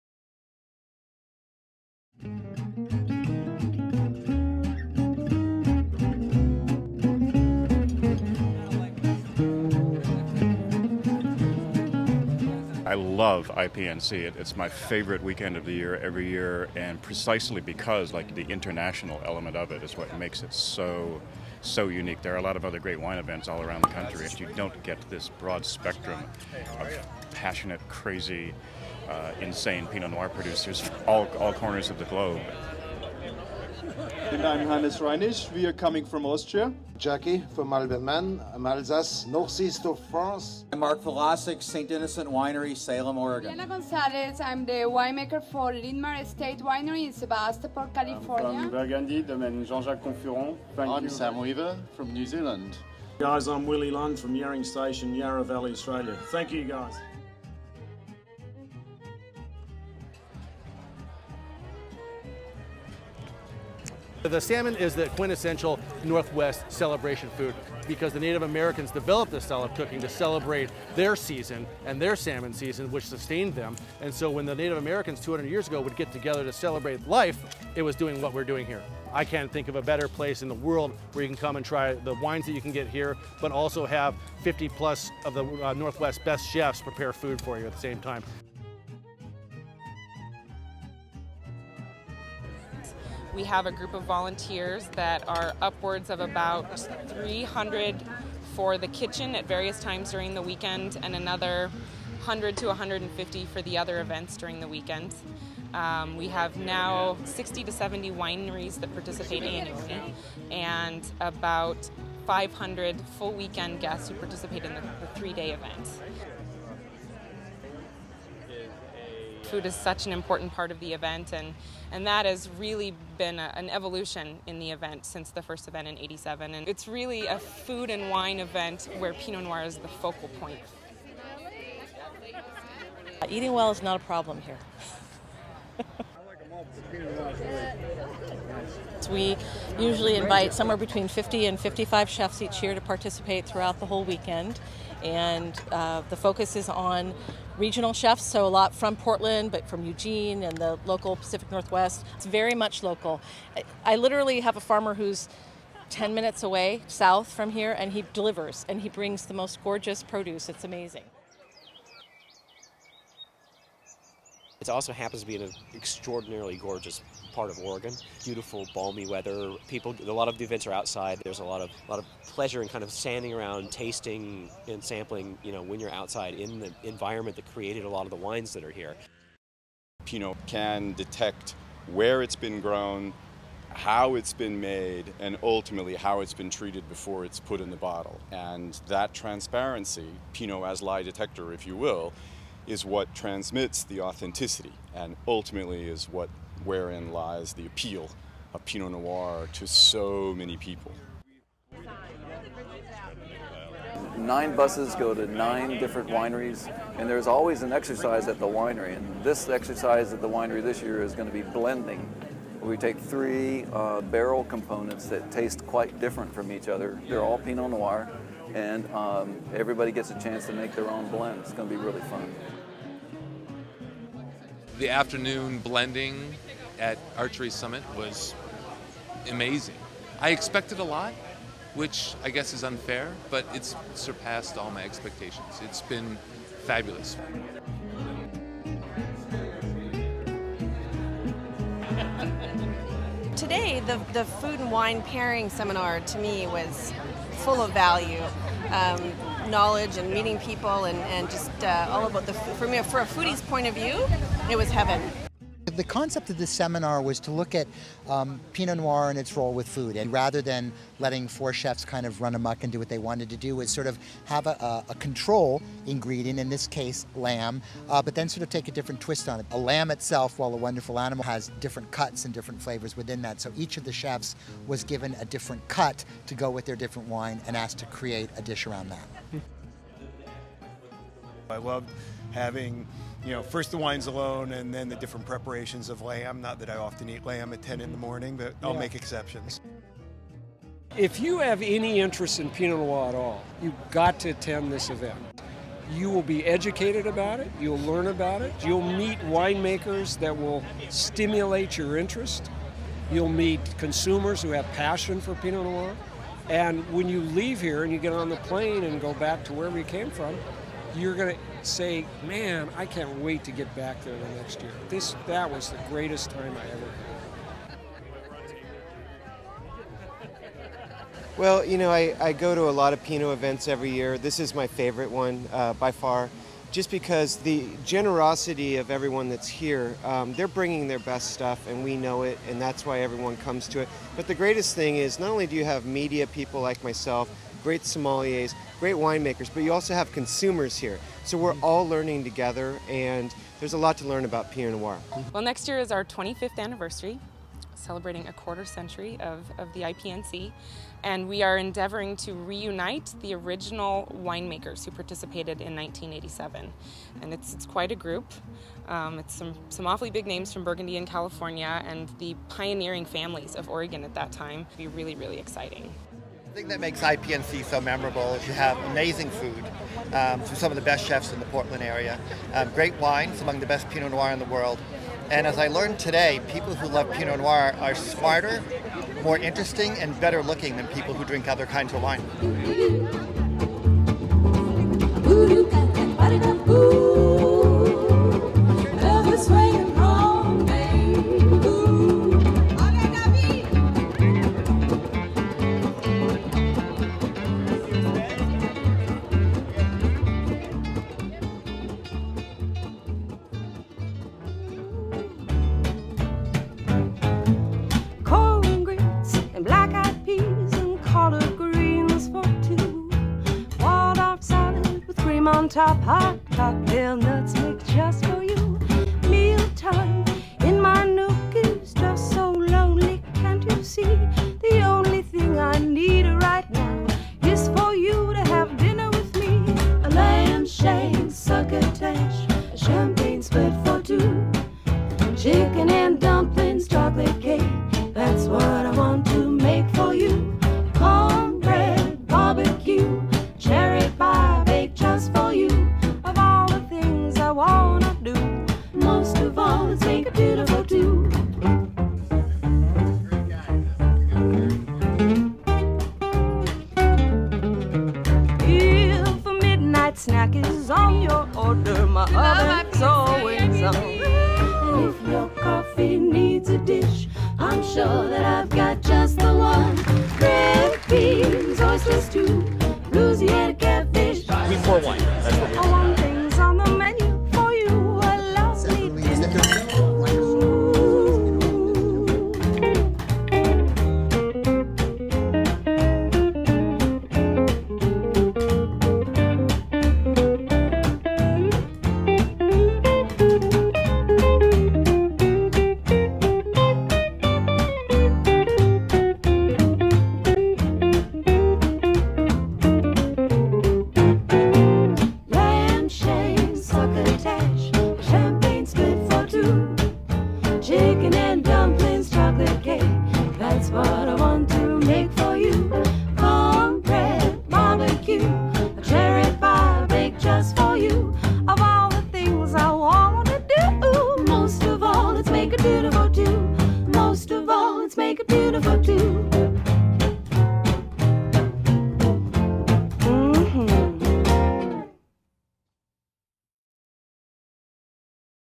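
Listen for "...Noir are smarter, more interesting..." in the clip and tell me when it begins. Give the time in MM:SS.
06:17.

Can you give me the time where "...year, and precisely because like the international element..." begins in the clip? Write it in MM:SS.
00:16.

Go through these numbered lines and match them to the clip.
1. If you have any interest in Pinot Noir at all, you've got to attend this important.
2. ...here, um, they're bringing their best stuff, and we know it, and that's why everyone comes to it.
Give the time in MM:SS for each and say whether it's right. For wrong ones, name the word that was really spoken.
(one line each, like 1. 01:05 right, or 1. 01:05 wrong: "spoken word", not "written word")
1. 04:50 wrong: "event", not "important"
2. 05:29 right.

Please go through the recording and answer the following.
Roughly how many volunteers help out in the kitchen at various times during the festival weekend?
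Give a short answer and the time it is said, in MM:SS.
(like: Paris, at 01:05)
300, at 01:37.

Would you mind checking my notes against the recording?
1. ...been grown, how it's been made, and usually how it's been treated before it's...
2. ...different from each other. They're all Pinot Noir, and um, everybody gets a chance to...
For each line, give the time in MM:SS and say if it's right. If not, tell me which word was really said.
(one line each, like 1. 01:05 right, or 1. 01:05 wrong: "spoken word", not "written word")
1. 03:02 wrong: "ultimately", not "usually"
2. 03:35 right.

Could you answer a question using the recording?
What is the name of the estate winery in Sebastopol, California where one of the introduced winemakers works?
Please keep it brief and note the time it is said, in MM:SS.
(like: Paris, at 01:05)
Lynmar Estate Winery, at 00:45.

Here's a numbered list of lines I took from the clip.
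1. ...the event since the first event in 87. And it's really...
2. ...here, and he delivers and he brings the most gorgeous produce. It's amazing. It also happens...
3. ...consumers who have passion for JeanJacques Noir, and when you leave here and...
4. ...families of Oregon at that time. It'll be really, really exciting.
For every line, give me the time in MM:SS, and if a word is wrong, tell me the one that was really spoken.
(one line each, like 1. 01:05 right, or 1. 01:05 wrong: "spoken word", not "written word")
1. 02:04 right
2. 02:37 right
3. 05:03 wrong: "Pinot", not "JeanJacques"
4. 06:03 right.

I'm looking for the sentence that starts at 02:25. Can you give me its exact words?
And uh, the focus is on regional chefs, so a lot from Portland, but from Eugene and the local Pacific Northwest.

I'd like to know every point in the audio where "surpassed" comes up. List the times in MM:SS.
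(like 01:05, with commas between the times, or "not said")
03:53.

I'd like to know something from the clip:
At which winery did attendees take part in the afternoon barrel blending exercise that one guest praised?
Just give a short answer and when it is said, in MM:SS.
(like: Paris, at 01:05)
Archery Summit, at 03:47.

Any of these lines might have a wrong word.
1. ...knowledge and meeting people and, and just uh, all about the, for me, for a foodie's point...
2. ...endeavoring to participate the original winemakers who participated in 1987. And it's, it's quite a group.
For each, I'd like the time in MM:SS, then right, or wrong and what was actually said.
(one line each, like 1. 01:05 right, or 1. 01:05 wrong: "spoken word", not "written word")
1. 04:09 right
2. 05:51 wrong: "reunite", not "participate".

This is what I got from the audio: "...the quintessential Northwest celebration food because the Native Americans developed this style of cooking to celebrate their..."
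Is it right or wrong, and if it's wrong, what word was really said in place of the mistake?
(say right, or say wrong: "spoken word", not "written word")
right.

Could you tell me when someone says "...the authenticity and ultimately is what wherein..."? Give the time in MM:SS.
03:13.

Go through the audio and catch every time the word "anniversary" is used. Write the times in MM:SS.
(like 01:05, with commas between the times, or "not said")
05:46.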